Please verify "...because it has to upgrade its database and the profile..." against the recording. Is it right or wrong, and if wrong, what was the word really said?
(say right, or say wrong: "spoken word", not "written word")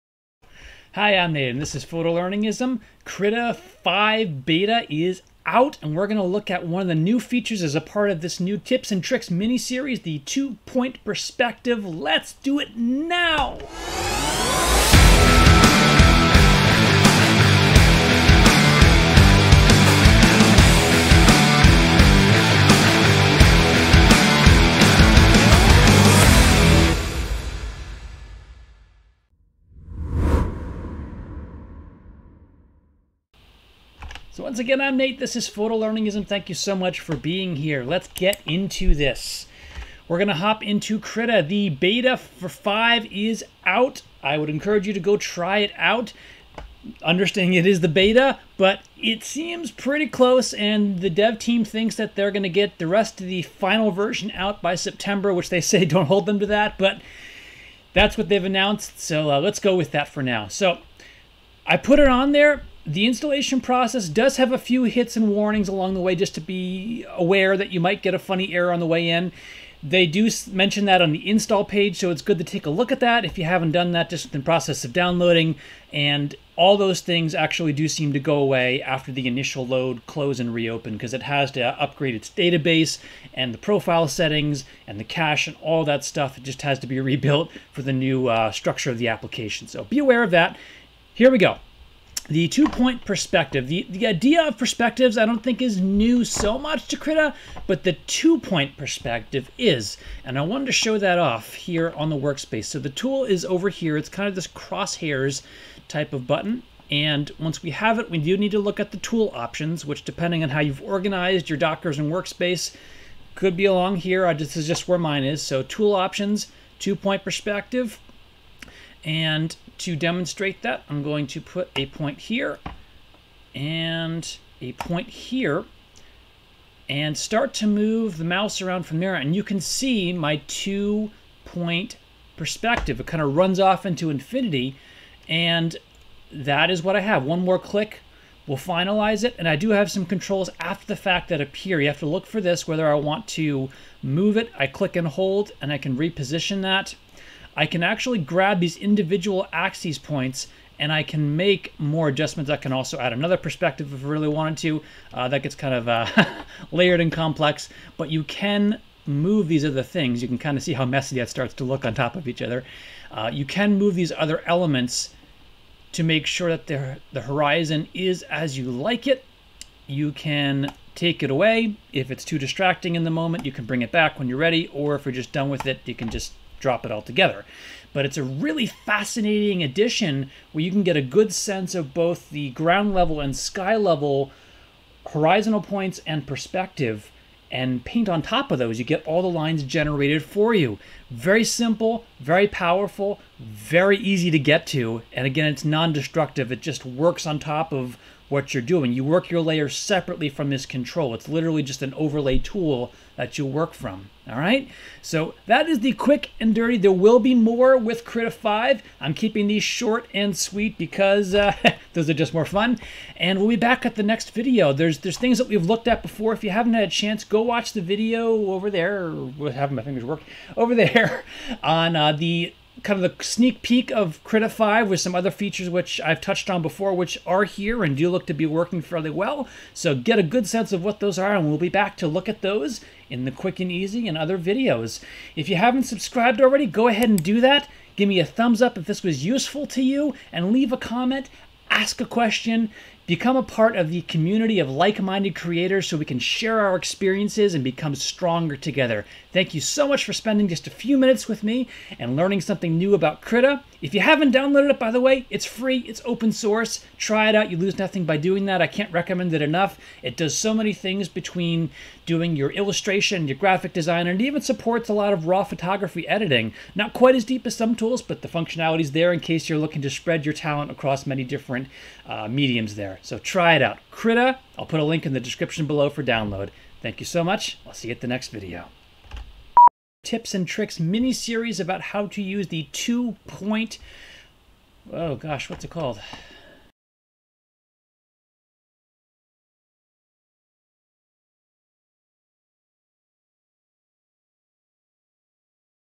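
right.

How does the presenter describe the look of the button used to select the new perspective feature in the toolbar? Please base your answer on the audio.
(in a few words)
Crosshairs.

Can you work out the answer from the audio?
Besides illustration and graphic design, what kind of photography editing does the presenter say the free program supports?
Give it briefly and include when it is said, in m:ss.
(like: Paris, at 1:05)
Raw photography editing, at 4:25.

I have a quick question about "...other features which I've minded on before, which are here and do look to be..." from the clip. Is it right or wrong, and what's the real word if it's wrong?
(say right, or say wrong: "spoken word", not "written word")
wrong: "touched", not "minded".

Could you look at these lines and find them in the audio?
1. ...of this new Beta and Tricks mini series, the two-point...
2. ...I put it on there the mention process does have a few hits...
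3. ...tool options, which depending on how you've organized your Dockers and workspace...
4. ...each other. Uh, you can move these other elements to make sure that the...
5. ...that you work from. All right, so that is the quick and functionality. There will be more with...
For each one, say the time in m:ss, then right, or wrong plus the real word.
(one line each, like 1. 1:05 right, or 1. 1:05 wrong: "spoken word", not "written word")
1. 0:08 wrong: "Tips", not "Beta"
2. 1:01 wrong: "installation", not "mention"
3. 1:48 right
4. 2:42 right
5. 3:23 wrong: "dirty", not "functionality".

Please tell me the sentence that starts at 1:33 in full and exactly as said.
The, the idea of perspectives I don't think is new so much to Krita, but the two point perspective is.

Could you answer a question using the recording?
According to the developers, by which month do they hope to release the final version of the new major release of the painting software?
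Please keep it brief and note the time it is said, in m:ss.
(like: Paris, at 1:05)
September, at 0:54.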